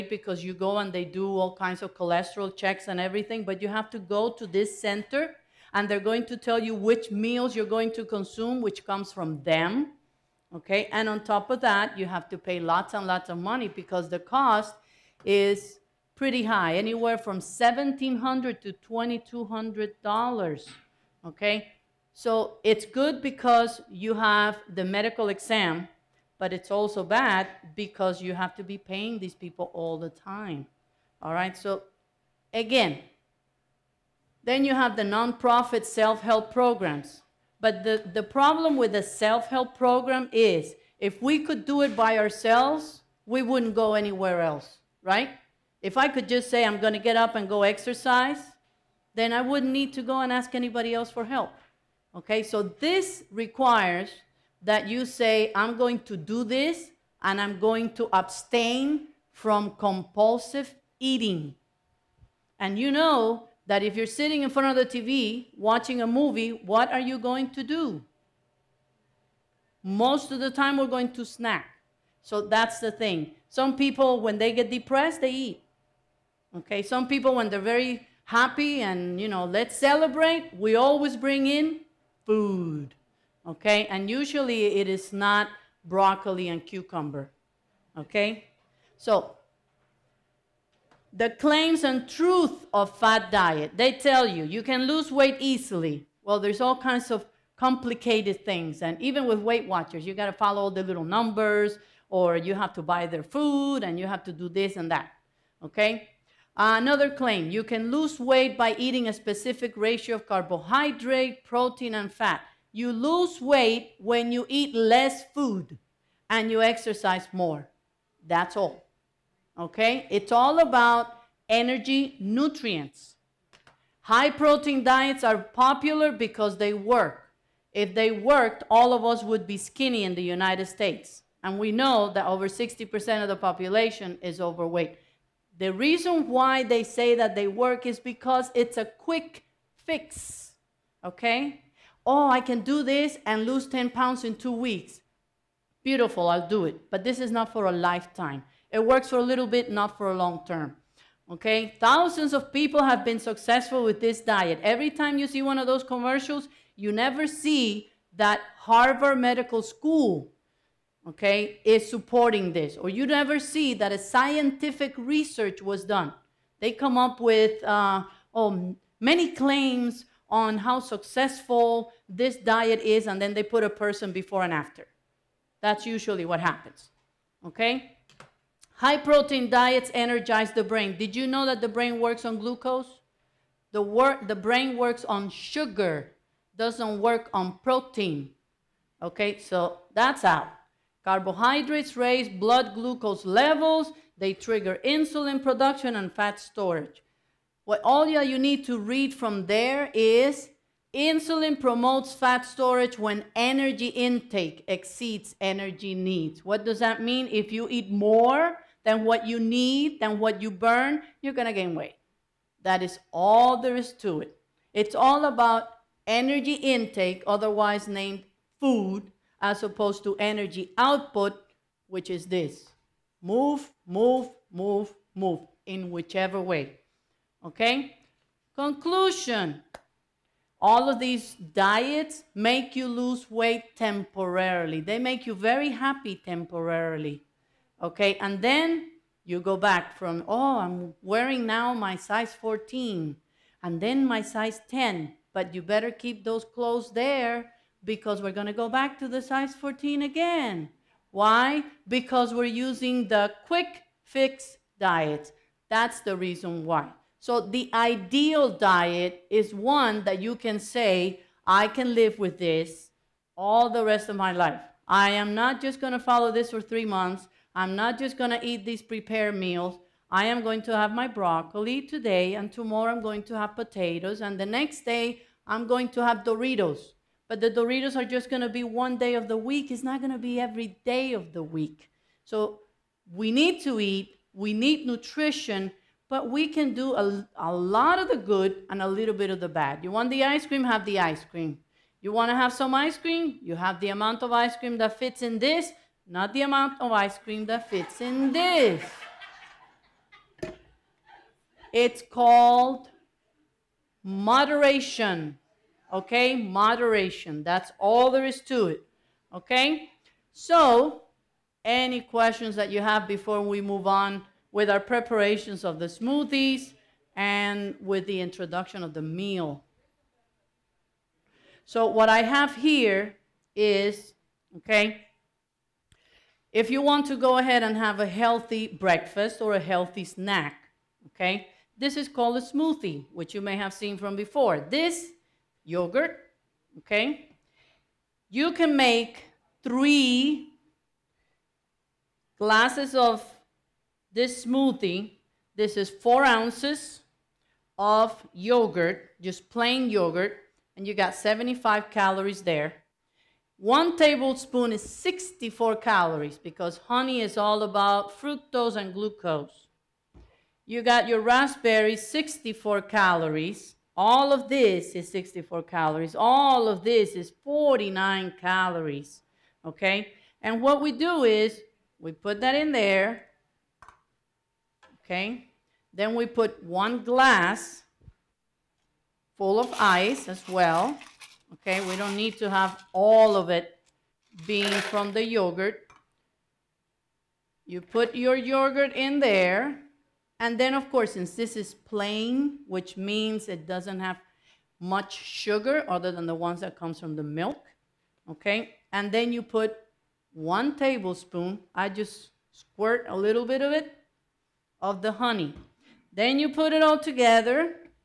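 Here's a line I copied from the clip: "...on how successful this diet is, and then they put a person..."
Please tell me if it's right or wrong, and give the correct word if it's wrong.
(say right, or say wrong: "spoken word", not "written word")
right.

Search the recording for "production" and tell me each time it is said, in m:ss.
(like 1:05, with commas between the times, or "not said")
3:15.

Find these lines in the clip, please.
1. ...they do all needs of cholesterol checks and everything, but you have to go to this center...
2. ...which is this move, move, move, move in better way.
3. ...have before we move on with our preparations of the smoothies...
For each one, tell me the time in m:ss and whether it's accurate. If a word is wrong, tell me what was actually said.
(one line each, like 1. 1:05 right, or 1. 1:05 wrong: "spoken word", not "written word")
1. 0:00 wrong: "kinds", not "needs"
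2. 3:41 wrong: "whichever", not "better"
3. 5:12 right.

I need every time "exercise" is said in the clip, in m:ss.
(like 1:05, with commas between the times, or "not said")
0:47, 1:56.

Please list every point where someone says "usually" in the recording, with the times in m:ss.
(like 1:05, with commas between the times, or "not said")
1:24, 2:55.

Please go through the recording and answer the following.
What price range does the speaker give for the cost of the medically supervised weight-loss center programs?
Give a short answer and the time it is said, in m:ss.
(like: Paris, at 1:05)
$1,700 to $2,200, at 0:17.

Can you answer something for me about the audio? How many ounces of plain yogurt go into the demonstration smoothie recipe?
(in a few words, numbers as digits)
4 ounces.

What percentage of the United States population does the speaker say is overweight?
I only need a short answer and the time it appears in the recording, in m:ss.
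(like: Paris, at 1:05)
over 60%, at 2:12.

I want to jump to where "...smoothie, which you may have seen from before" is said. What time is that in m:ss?
5:32.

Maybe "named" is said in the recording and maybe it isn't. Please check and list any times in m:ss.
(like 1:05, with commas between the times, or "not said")
3:37.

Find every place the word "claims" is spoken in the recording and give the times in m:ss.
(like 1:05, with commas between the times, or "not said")
1:31, 1:47, 2:49.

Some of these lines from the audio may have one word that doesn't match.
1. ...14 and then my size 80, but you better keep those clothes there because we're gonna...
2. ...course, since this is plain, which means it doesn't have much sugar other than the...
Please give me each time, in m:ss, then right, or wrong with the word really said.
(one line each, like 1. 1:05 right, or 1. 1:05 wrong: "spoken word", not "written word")
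1. 4:02 wrong: "10", not "80"
2. 6:30 right.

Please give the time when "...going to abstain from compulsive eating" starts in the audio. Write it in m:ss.
0:57.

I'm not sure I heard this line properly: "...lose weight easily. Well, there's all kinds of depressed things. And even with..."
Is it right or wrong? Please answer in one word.
wrong.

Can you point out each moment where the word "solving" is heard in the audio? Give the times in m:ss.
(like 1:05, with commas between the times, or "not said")
not said.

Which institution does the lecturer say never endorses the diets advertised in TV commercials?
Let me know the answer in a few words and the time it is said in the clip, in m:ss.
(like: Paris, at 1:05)
Harvard Medical School, at 2:38.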